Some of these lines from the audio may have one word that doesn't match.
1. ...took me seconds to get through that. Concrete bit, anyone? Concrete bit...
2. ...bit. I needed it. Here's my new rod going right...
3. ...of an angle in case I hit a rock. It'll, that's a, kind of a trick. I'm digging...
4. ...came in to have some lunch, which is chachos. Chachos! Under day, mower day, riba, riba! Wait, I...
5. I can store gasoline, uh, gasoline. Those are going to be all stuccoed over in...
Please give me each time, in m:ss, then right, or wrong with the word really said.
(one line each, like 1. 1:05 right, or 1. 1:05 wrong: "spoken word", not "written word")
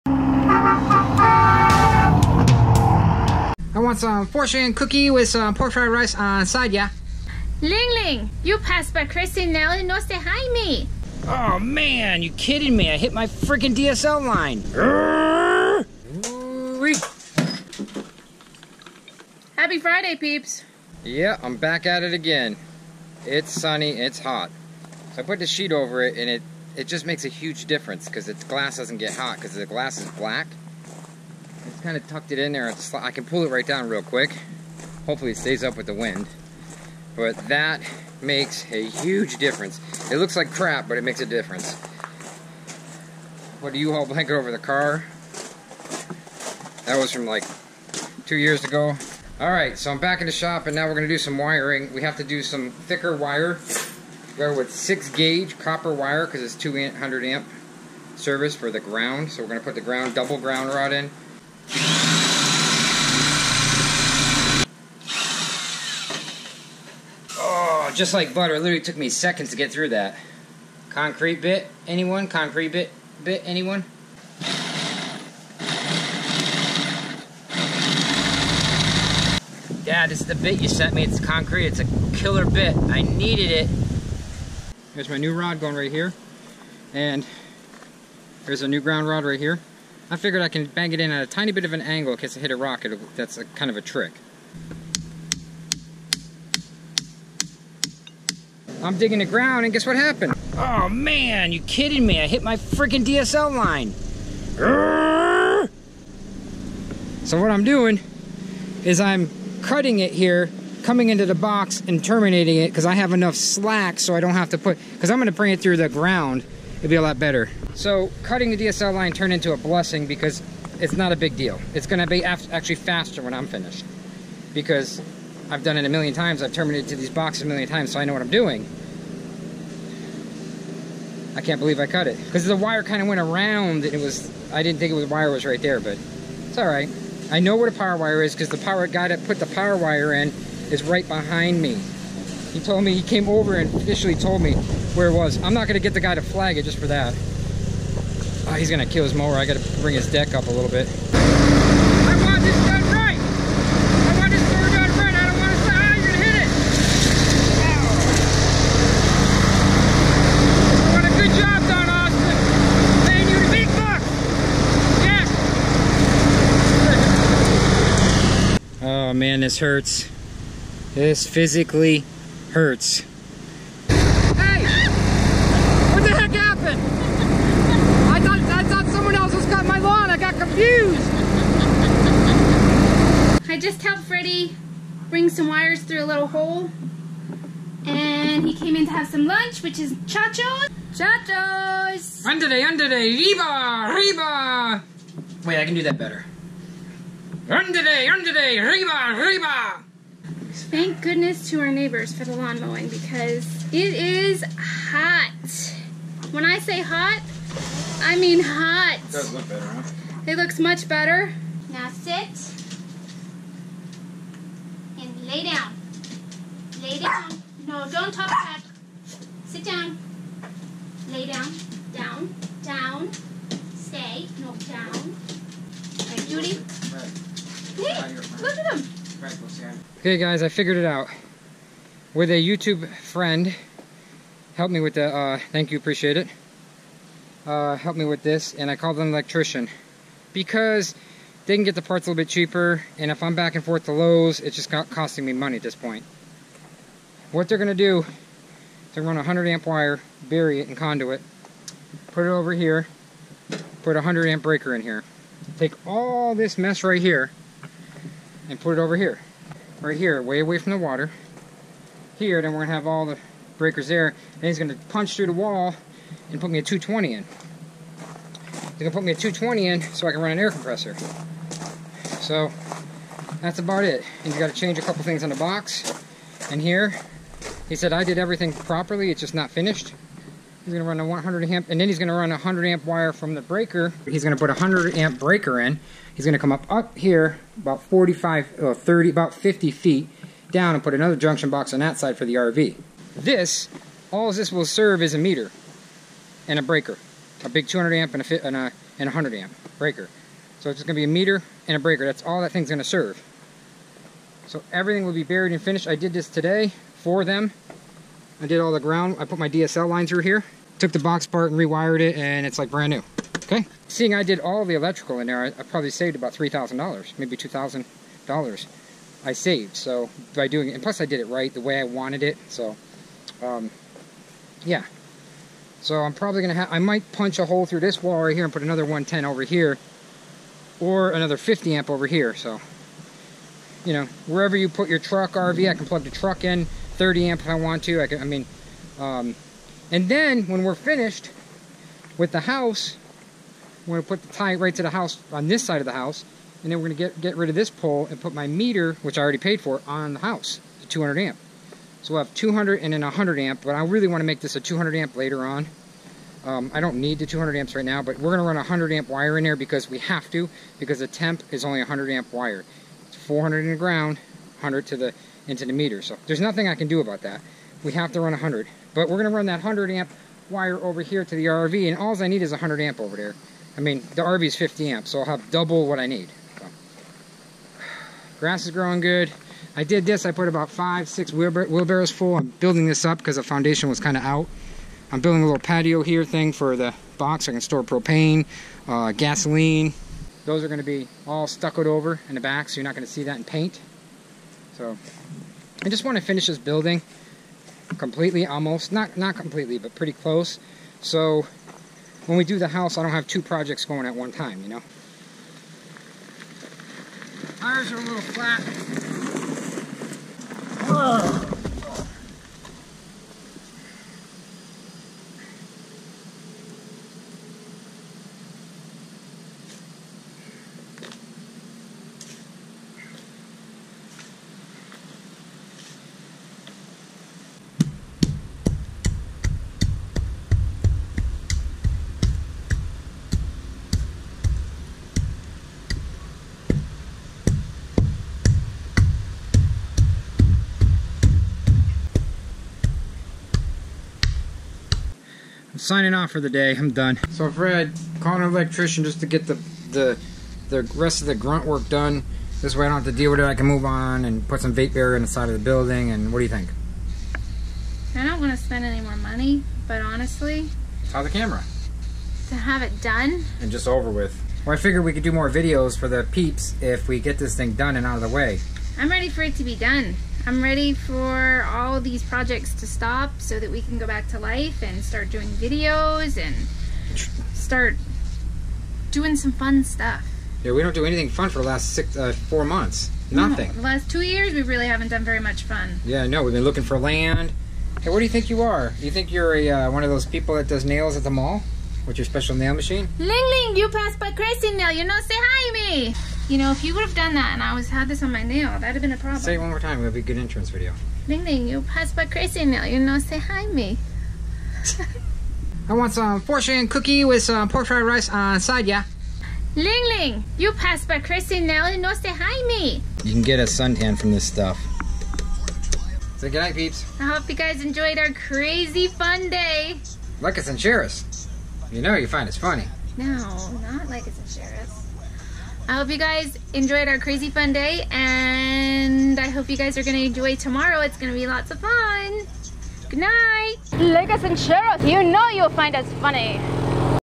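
1. 1:08 right
2. 1:22 right
3. 1:31 right
4. 3:08 wrong: "under", not "mower"
5. 6:27 wrong: "propane", not "gasoline".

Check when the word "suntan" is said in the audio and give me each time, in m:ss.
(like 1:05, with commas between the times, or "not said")
8:33.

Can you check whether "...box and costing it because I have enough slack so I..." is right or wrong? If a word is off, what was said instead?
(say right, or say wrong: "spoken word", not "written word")
wrong: "terminating", not "costing".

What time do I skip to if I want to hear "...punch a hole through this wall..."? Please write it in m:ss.
5:27.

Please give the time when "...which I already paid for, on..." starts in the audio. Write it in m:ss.
5:49.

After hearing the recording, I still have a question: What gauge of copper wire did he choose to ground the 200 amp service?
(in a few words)
6 gauge.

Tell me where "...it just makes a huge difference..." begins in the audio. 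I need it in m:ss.
0:26.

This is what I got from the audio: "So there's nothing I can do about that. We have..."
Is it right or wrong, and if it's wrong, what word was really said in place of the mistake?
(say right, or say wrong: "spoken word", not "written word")
right.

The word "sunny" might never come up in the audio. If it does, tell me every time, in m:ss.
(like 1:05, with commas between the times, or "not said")
0:23.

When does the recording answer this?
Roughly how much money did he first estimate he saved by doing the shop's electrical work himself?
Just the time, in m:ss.
5:16.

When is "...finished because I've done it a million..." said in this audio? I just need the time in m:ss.
2:03.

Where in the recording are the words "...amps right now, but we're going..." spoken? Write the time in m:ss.
5:57.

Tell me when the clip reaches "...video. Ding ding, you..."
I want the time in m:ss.
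8:20.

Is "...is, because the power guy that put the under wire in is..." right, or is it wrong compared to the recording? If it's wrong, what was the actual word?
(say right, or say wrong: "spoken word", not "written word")
wrong: "power", not "under".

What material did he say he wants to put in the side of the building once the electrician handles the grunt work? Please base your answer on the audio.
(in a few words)
Vapor barrier.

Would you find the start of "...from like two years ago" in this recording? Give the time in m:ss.
0:47.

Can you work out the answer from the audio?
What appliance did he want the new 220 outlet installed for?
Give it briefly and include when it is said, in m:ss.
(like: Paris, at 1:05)
Air compressor, at 4:30.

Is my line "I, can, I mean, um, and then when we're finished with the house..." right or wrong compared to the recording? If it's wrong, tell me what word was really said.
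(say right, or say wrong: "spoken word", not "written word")
right.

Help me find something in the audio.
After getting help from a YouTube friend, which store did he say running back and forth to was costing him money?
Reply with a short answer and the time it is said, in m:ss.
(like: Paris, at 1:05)
Lowe's, at 4:03.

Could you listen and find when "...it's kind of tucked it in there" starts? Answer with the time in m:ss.
0:31.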